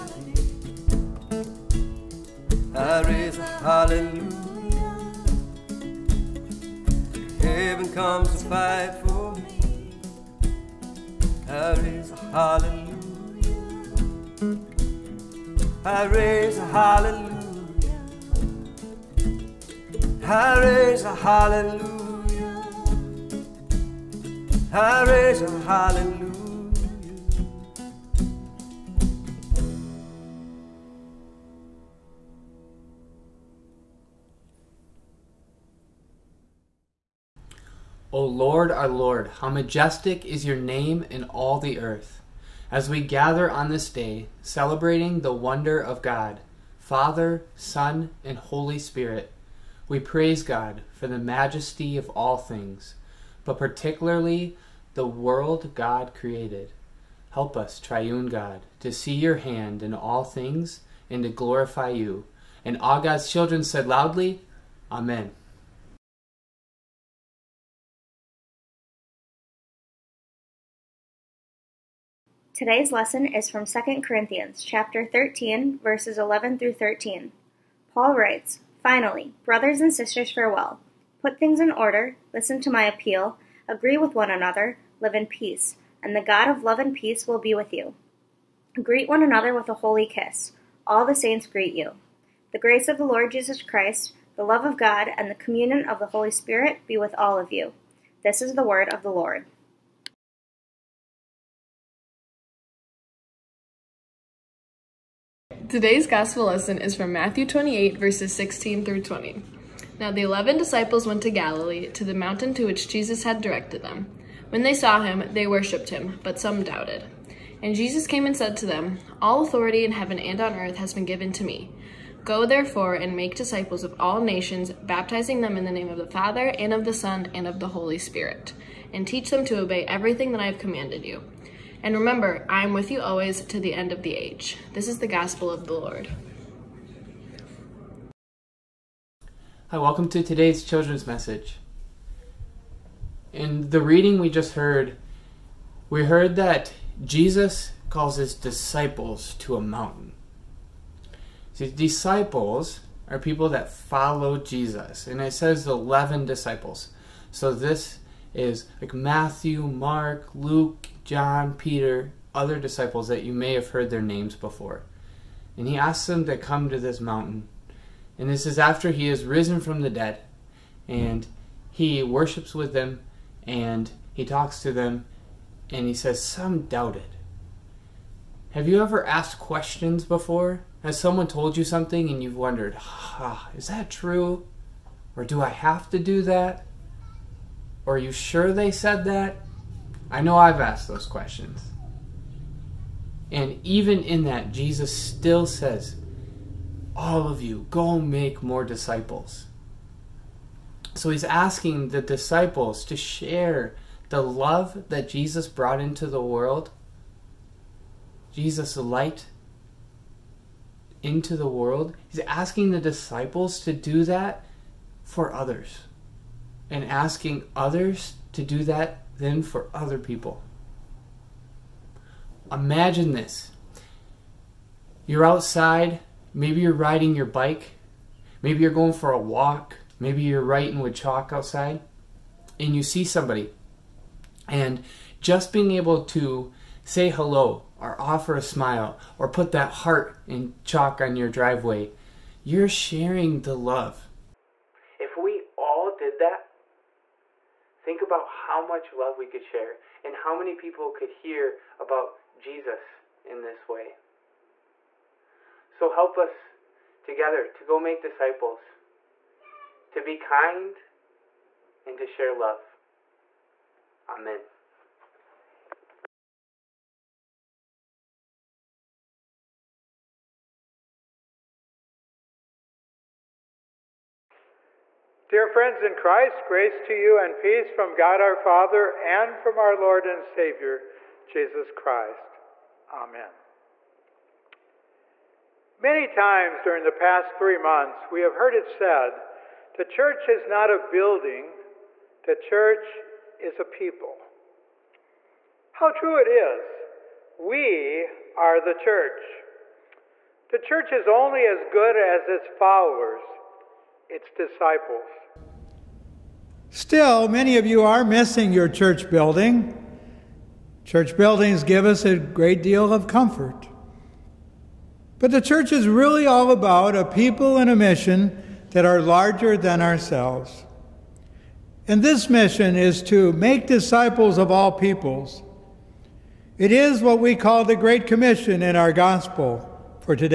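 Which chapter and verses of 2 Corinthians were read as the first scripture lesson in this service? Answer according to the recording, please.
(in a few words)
13, verses 11-13.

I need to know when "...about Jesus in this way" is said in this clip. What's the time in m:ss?
4:11.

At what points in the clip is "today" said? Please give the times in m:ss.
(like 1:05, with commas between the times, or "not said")
1:12, 1:45, 2:20.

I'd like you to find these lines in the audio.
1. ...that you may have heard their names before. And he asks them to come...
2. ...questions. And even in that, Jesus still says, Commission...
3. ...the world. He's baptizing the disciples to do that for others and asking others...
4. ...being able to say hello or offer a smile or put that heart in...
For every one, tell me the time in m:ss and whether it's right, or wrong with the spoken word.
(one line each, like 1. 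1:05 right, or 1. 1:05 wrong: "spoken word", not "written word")
1. 2:43 right
2. 3:11 wrong: "All", not "Commission"
3. 3:31 wrong: "asking", not "baptizing"
4. 3:55 right.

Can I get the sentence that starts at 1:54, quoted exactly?
When they saw him, they worshipped him, but some doubted.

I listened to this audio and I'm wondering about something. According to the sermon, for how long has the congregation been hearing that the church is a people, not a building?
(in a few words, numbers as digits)
3 months.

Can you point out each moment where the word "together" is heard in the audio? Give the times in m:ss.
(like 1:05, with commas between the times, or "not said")
4:17.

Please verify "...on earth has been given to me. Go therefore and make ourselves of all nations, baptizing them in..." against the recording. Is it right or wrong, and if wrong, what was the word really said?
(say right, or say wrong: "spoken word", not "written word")
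wrong: "disciples", not "ourselves".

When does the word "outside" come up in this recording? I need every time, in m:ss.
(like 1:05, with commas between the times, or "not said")
3:45, 3:51.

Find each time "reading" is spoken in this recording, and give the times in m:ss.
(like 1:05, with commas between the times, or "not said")
2:23.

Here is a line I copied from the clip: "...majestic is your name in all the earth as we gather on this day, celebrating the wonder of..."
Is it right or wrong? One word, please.
right.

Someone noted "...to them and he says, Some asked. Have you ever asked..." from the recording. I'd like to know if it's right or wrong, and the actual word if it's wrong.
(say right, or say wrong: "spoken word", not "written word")
wrong: "doubted", not "asked".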